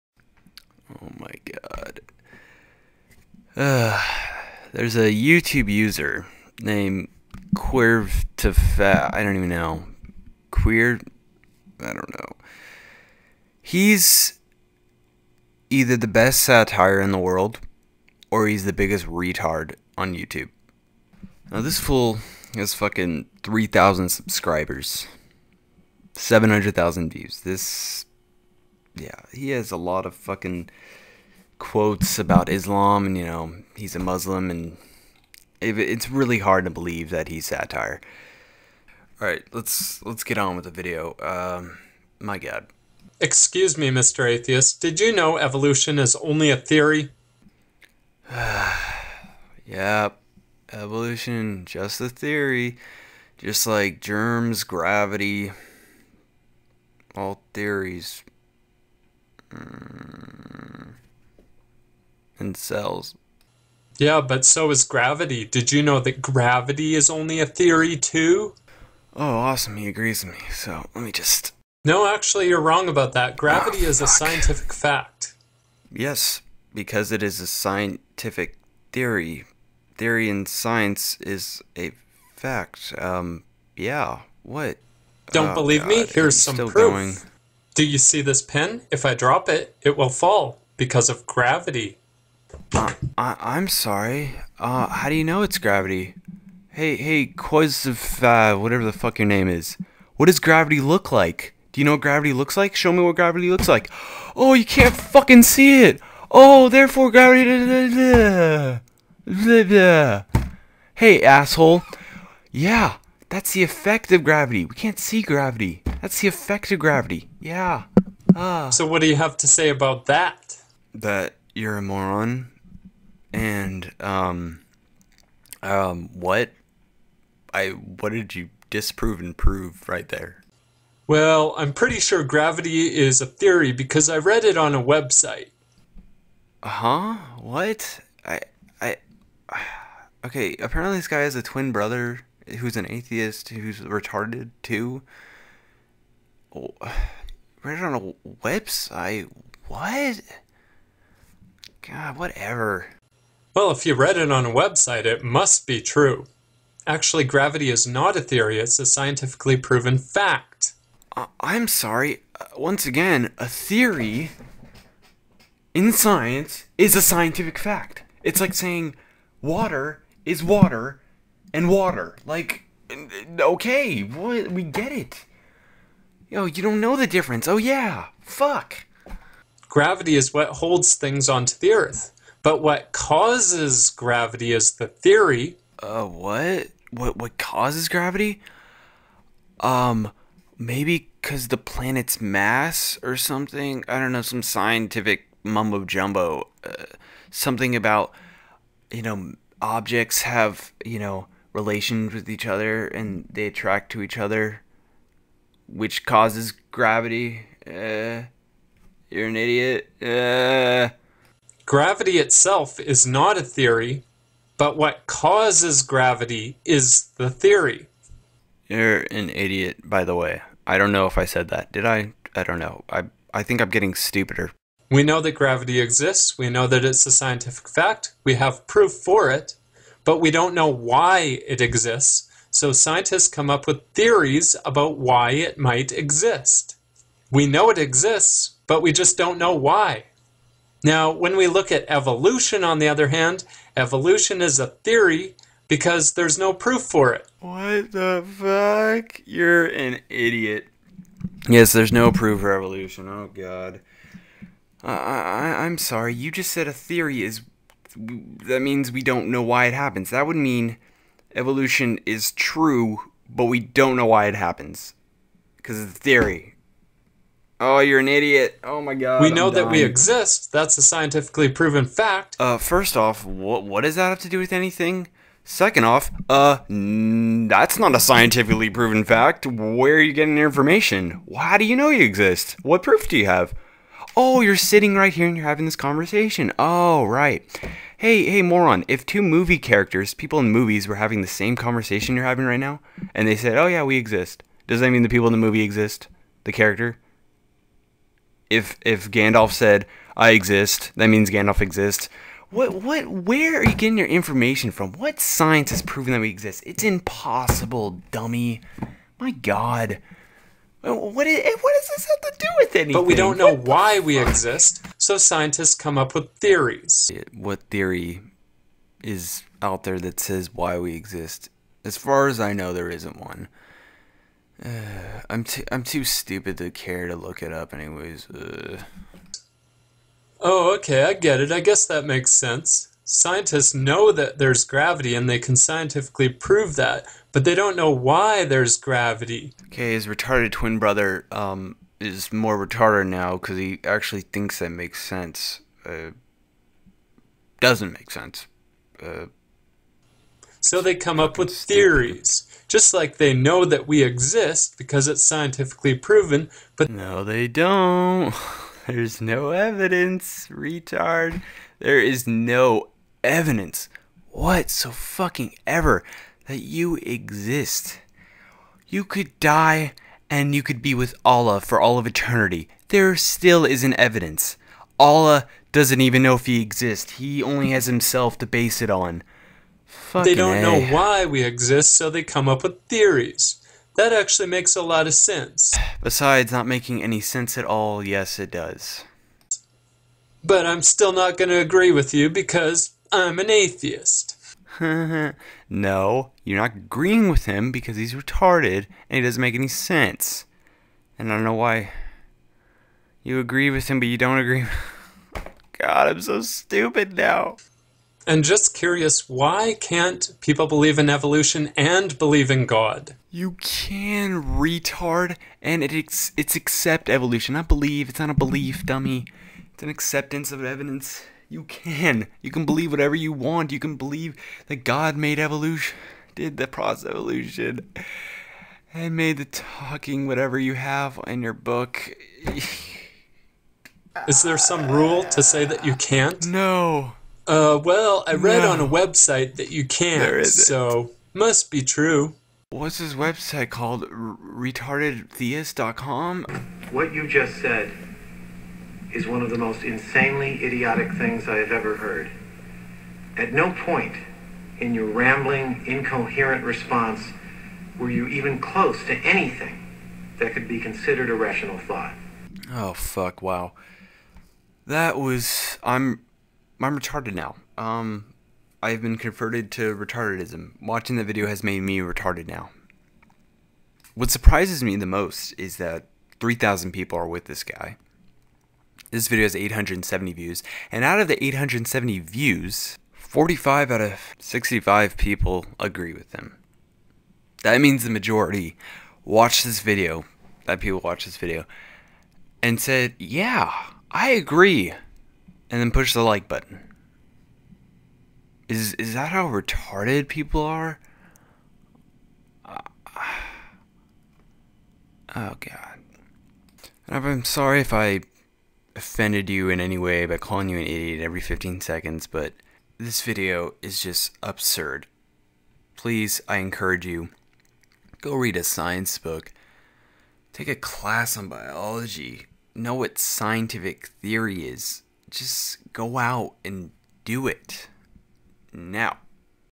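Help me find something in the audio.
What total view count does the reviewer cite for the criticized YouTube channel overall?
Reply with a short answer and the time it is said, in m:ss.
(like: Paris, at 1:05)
700,000, at 0:26.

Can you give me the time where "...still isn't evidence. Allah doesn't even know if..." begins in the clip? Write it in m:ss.
6:13.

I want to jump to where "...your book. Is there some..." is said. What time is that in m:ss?
7:11.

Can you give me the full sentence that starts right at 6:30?
But I'm still not going to agree with you because I'm an atheist.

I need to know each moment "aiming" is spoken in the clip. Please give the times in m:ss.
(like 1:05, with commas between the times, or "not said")
not said.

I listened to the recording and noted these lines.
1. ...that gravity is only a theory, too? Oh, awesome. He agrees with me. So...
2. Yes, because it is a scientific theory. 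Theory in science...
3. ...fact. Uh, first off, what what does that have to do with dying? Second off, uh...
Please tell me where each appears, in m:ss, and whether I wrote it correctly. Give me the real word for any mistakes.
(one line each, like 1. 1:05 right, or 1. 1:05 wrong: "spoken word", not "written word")
1. 1:06 right
2. 1:15 right
3. 4:31 wrong: "anything", not "dying".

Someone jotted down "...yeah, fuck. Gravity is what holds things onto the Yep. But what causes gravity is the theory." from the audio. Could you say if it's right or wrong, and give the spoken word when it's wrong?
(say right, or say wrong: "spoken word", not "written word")
wrong: "Earth", not "Yep".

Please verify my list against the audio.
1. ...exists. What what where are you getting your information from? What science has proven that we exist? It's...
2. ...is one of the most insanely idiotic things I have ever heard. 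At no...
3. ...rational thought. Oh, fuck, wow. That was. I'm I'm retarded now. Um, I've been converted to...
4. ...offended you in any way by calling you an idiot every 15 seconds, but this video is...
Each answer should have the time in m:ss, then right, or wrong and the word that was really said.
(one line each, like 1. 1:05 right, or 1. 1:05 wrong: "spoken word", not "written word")
1. 5:01 right
2. 7:29 right
3. 7:41 right
4. 8:28 right.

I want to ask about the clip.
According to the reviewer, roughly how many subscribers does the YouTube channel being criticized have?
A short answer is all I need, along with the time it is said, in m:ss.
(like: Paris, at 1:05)
3,000, at 0:23.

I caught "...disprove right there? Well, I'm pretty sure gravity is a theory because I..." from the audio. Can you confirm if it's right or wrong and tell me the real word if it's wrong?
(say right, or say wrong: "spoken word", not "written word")
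wrong: "prove", not "disprove".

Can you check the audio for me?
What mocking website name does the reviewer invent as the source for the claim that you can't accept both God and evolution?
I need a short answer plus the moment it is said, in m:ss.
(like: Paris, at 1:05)
RetardedTheist.com, at 7:24.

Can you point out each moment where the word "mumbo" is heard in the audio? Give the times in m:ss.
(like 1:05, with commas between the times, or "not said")
3:15.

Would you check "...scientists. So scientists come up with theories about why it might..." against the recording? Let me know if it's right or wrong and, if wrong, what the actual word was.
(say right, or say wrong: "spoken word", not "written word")
wrong: "exists", not "scientists".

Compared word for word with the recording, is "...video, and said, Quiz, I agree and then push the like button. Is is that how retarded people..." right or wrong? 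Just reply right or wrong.
wrong.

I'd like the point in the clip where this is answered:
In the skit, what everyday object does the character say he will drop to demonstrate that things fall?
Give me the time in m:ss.
1:28.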